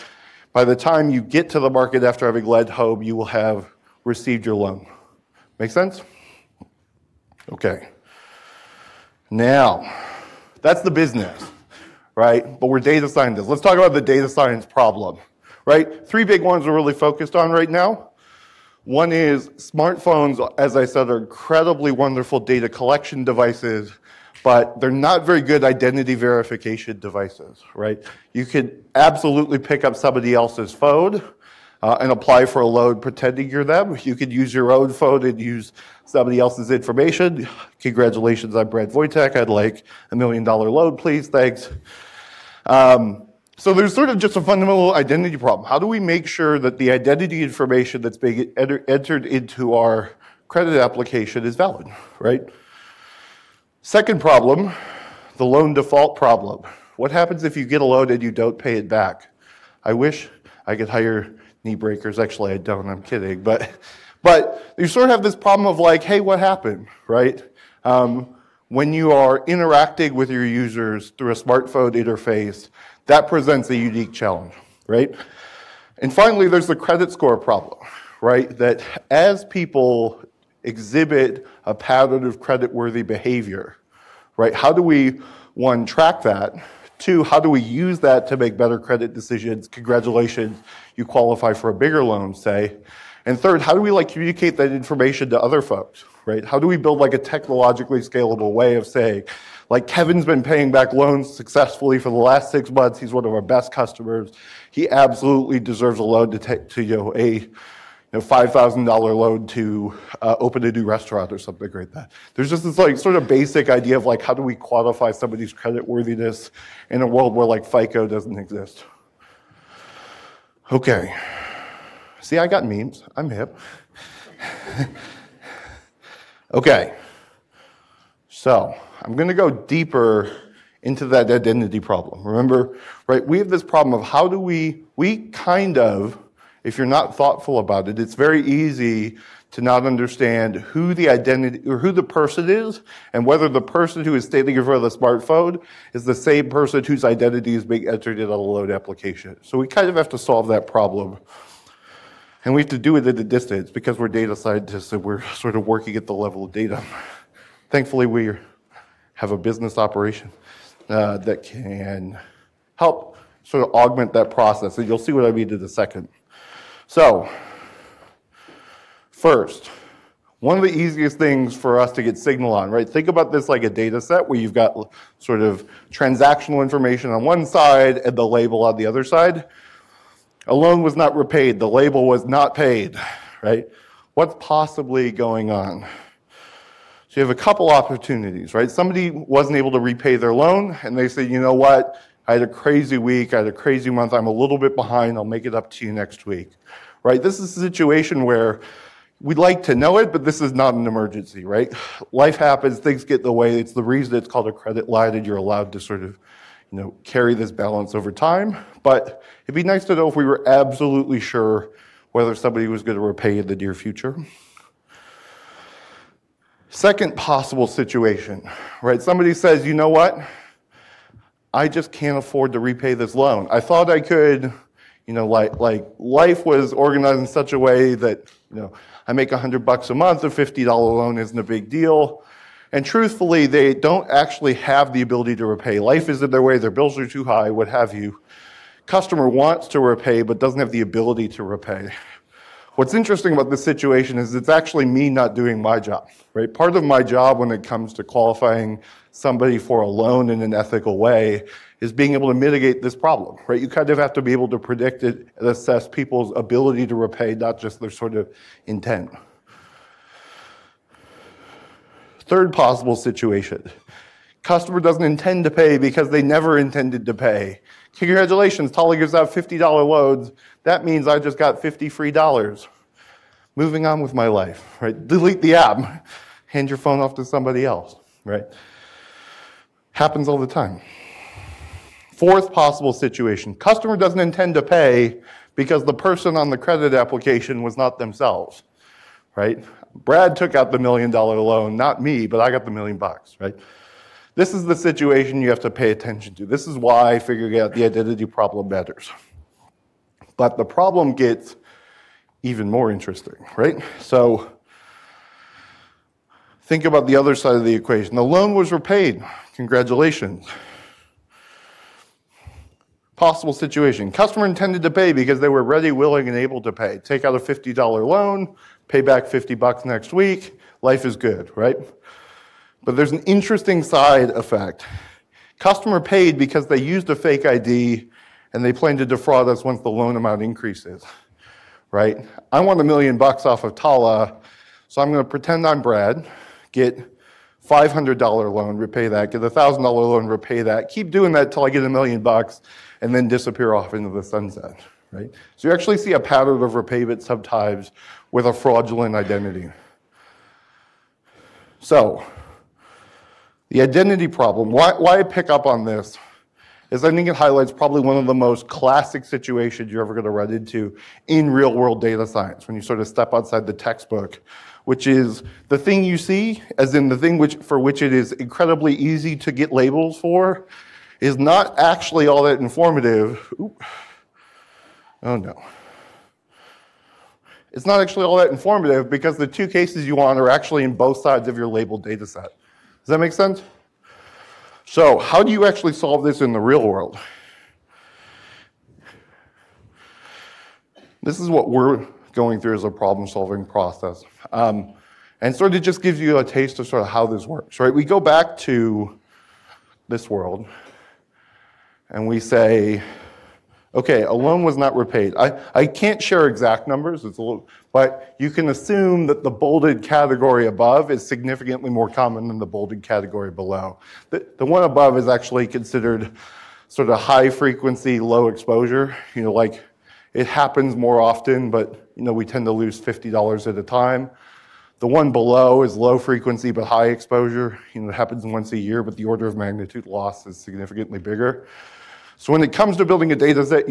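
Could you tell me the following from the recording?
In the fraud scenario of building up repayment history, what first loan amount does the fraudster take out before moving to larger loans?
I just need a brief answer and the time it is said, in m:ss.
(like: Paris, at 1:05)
$500, at 5:37.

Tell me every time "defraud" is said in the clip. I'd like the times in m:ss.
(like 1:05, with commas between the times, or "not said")
5:29.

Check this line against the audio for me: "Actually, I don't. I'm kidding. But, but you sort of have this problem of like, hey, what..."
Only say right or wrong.
right.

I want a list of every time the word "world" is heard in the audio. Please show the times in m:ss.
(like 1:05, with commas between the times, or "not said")
1:57, 6:01, 6:26, 6:40.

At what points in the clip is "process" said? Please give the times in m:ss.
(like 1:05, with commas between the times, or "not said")
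2:44, 6:33.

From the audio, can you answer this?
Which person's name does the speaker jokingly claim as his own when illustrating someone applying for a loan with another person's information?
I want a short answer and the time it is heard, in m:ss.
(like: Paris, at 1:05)
Brad Voytek, at 0:38.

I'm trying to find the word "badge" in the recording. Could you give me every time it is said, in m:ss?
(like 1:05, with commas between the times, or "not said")
not said.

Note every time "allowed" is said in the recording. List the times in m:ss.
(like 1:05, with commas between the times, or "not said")
3:25.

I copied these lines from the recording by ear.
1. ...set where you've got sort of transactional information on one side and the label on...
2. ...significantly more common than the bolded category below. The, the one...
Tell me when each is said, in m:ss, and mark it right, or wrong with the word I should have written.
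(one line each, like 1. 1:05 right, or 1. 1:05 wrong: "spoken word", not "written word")
1. 2:54 right
2. 6:51 right.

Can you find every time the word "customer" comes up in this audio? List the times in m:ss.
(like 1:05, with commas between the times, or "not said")
1:43, 3:58, 4:24, 4:43, 5:14, 5:25.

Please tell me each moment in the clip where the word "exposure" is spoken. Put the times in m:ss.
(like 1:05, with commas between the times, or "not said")
6:58, 7:07.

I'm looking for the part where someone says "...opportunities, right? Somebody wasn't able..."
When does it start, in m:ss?
3:07.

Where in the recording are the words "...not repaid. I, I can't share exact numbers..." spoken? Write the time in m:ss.
6:44.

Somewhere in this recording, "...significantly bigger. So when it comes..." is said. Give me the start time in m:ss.
7:10.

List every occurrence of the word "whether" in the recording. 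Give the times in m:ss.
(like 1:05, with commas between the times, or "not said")
2:23, 3:32.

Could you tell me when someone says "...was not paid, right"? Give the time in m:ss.
3:02.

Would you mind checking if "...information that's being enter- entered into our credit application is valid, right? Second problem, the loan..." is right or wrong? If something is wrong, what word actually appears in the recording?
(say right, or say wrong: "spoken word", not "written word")
right.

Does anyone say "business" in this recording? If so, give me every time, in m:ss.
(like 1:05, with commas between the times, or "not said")
0:10, 2:39.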